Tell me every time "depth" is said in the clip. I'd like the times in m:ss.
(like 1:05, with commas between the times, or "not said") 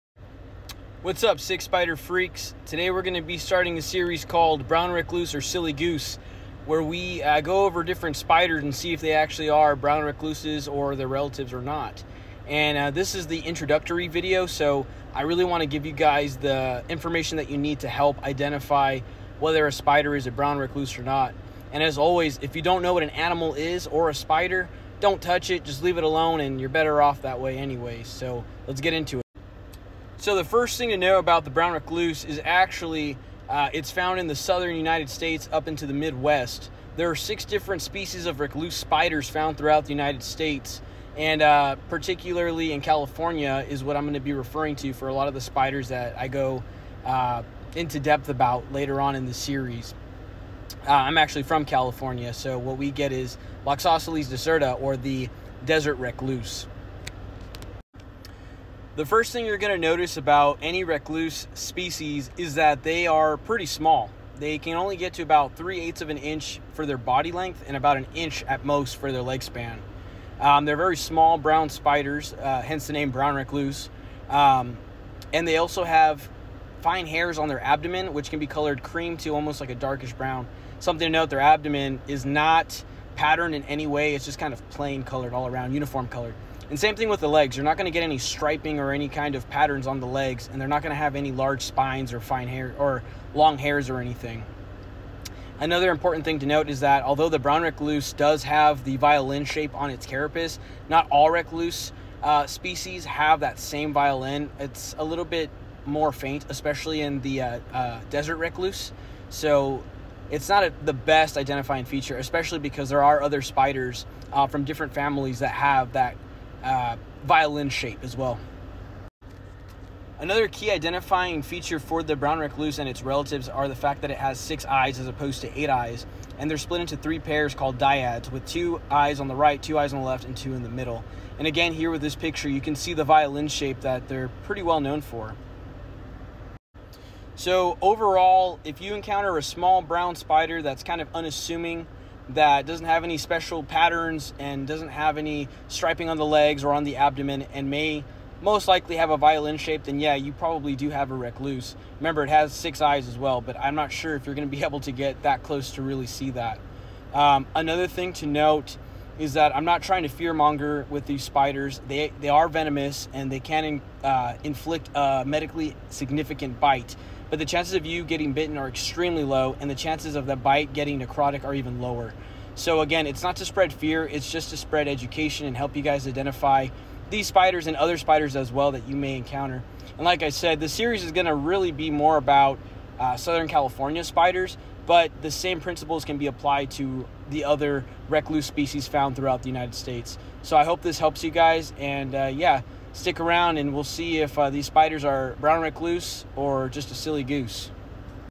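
0:47.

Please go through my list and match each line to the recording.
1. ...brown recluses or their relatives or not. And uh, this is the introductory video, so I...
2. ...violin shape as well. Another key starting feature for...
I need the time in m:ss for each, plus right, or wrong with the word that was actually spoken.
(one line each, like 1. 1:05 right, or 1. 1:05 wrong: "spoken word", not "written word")
1. 0:09 right
2. 1:57 wrong: "identifying", not "starting".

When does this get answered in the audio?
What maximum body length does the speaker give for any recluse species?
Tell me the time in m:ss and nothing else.
1:05.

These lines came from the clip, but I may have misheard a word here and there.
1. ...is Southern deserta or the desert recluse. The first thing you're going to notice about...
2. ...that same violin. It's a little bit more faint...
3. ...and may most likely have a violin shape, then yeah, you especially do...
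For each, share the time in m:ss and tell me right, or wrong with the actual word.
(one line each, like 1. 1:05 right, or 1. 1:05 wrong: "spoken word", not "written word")
1. 0:53 wrong: "Loxosceles", not "Southern"
2. 1:43 right
3. 2:27 wrong: "probably", not "especially".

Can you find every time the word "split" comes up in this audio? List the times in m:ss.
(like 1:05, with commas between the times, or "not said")
2:06.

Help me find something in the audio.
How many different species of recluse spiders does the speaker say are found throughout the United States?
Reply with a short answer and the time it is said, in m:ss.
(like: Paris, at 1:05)
6, at 0:37.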